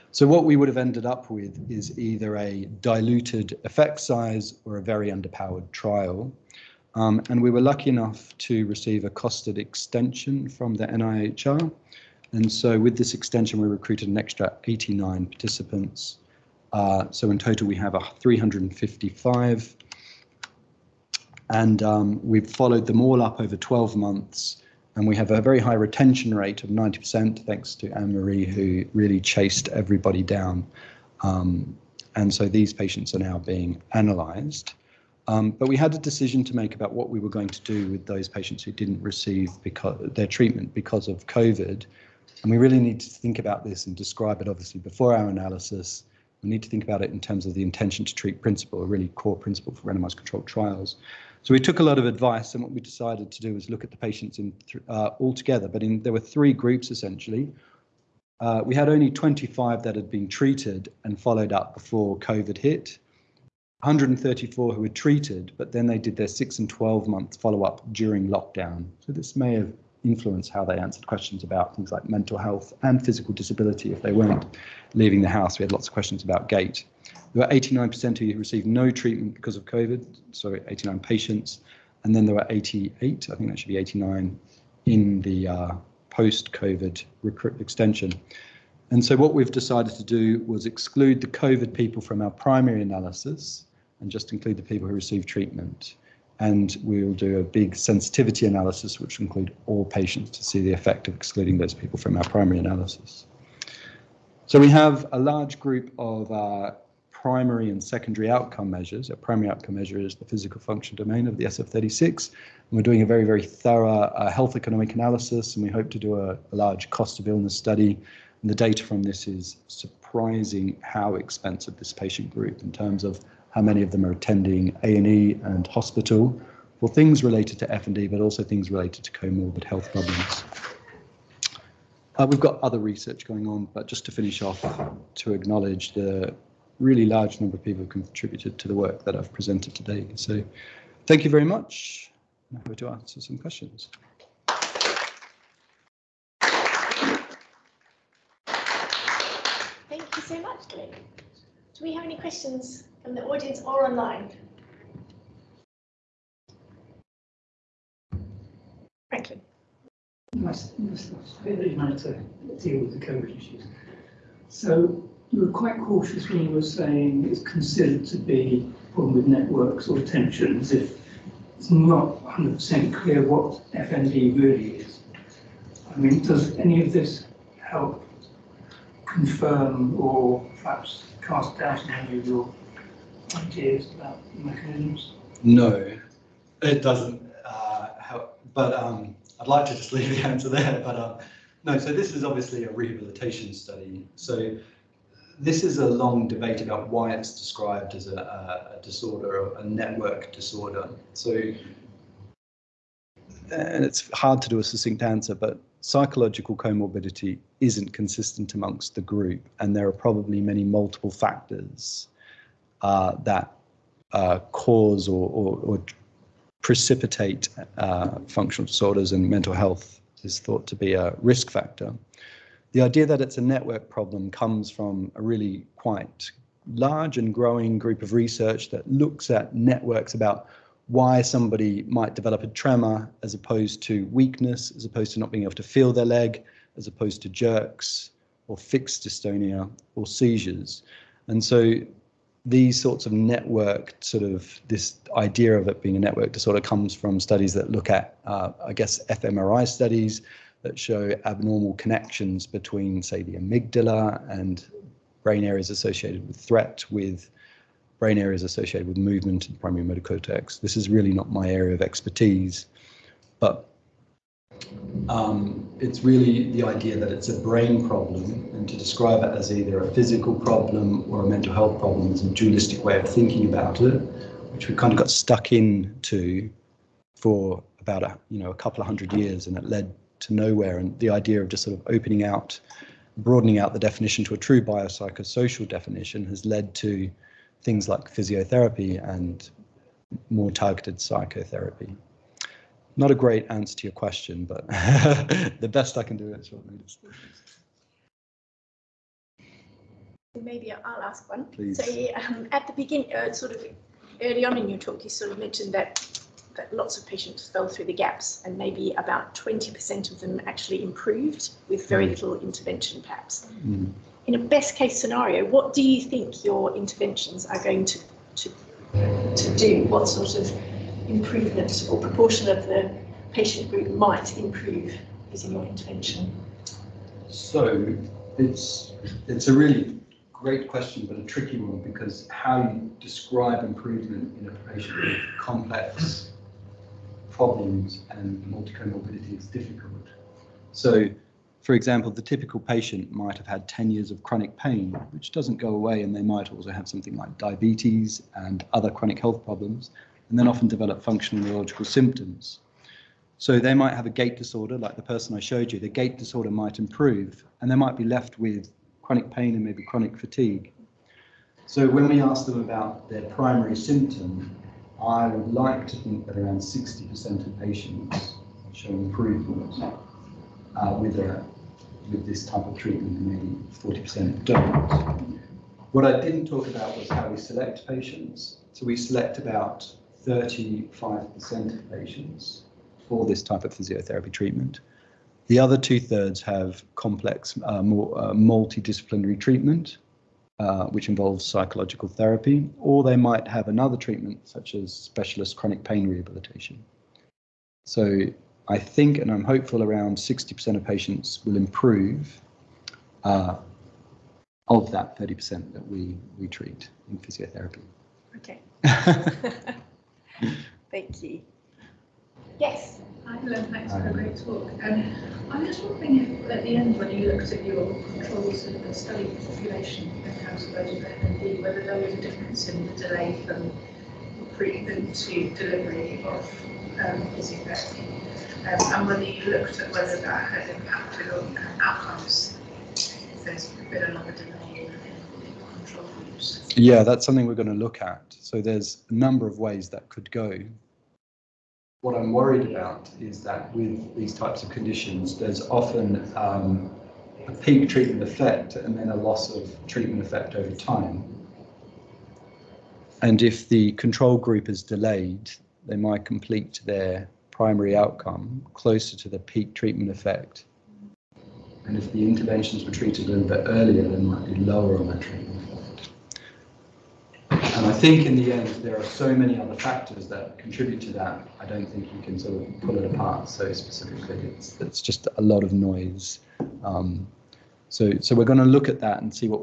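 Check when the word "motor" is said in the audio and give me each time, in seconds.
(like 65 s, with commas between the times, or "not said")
259 s.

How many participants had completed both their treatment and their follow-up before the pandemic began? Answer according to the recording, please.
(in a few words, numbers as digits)
25.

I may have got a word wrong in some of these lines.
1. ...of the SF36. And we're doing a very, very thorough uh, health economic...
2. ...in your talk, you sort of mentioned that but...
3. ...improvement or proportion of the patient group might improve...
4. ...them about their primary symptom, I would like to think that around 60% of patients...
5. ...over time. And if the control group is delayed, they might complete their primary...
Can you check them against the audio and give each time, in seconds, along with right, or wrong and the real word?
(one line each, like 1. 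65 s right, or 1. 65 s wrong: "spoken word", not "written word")
1. 111 s right
2. 304 s right
3. 321 s right
4. 362 s right
5. 450 s right.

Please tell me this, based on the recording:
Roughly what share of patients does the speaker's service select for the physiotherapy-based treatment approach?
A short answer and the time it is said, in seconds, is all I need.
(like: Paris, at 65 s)
35%, at 380 s.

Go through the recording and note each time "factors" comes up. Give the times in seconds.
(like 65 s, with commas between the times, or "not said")
211 s, 221 s, 469 s.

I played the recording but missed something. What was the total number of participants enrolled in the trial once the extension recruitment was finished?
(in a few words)
355.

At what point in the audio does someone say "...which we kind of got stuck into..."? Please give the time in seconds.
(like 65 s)
274 s.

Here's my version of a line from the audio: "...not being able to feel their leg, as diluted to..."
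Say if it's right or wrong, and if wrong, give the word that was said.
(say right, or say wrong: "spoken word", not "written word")
wrong: "opposed", not "diluted".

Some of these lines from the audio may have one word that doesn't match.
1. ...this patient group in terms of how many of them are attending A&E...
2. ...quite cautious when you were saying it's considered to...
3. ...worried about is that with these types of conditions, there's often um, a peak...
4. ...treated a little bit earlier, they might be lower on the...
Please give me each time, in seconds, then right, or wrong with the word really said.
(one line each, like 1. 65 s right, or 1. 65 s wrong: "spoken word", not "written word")
1. 121 s right
2. 165 s right
3. 442 s right
4. 462 s right.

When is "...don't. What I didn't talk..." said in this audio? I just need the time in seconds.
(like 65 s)
374 s.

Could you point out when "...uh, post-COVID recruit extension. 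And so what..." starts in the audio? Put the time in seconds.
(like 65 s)
85 s.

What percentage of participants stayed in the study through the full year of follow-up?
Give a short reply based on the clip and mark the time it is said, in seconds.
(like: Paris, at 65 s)
90%, at 26 s.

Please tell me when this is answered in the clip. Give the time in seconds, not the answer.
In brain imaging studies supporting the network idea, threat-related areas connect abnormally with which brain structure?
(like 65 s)
253 s.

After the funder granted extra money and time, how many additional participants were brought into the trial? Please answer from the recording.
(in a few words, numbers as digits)
89.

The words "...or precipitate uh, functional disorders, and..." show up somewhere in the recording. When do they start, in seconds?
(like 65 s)
215 s.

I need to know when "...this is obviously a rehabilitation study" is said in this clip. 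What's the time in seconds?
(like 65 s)
191 s.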